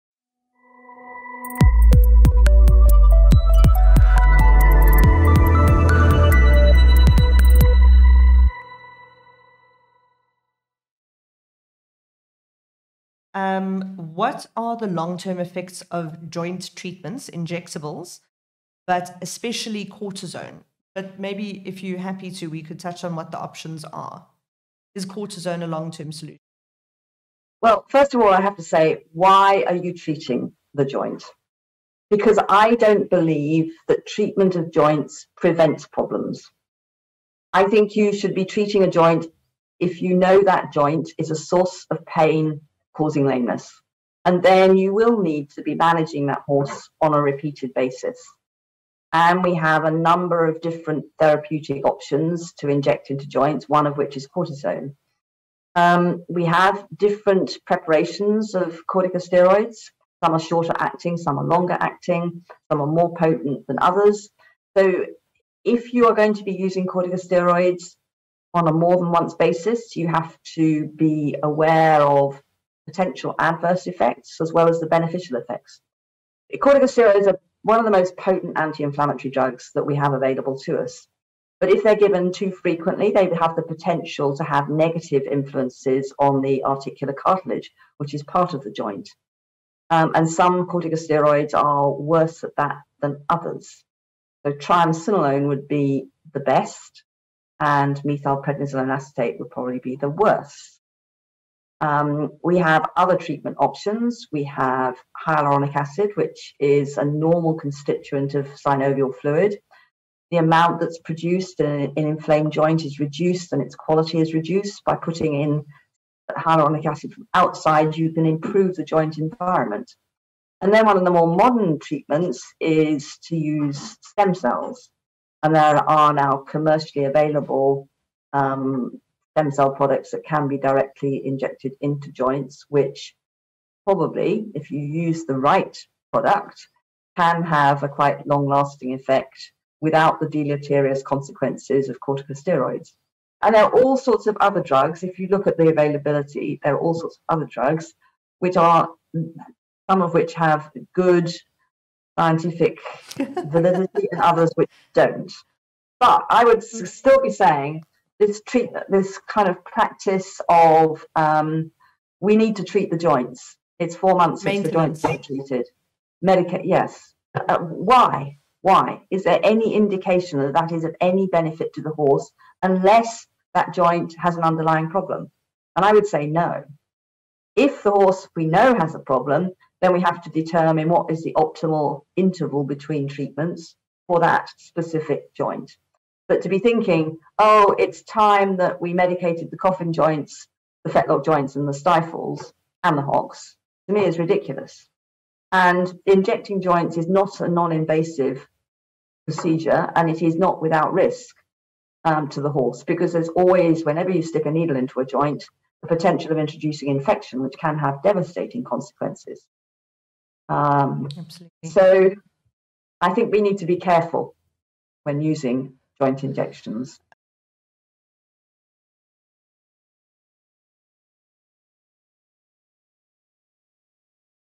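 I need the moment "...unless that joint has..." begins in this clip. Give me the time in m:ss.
2:52.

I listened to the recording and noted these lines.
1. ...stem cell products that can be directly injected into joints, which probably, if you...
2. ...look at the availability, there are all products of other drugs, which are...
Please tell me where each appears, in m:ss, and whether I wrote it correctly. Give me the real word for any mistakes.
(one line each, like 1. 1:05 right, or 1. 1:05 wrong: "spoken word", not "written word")
1. 2:09 right
2. 2:25 wrong: "sorts", not "products".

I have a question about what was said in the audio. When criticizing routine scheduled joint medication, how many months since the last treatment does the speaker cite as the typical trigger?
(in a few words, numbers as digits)
4 months.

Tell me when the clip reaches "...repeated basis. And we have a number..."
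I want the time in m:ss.
0:47.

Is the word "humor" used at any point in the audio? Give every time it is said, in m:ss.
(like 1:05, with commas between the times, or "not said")
not said.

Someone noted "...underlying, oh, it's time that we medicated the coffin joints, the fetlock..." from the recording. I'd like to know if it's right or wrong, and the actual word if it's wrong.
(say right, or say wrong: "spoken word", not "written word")
wrong: "thinking", not "underlying".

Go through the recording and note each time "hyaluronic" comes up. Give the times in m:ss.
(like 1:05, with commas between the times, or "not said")
1:45, 1:56.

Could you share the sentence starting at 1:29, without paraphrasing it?
Um, and some corticosteroids are worse at that than others.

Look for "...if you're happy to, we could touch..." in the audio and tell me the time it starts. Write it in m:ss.
0:21.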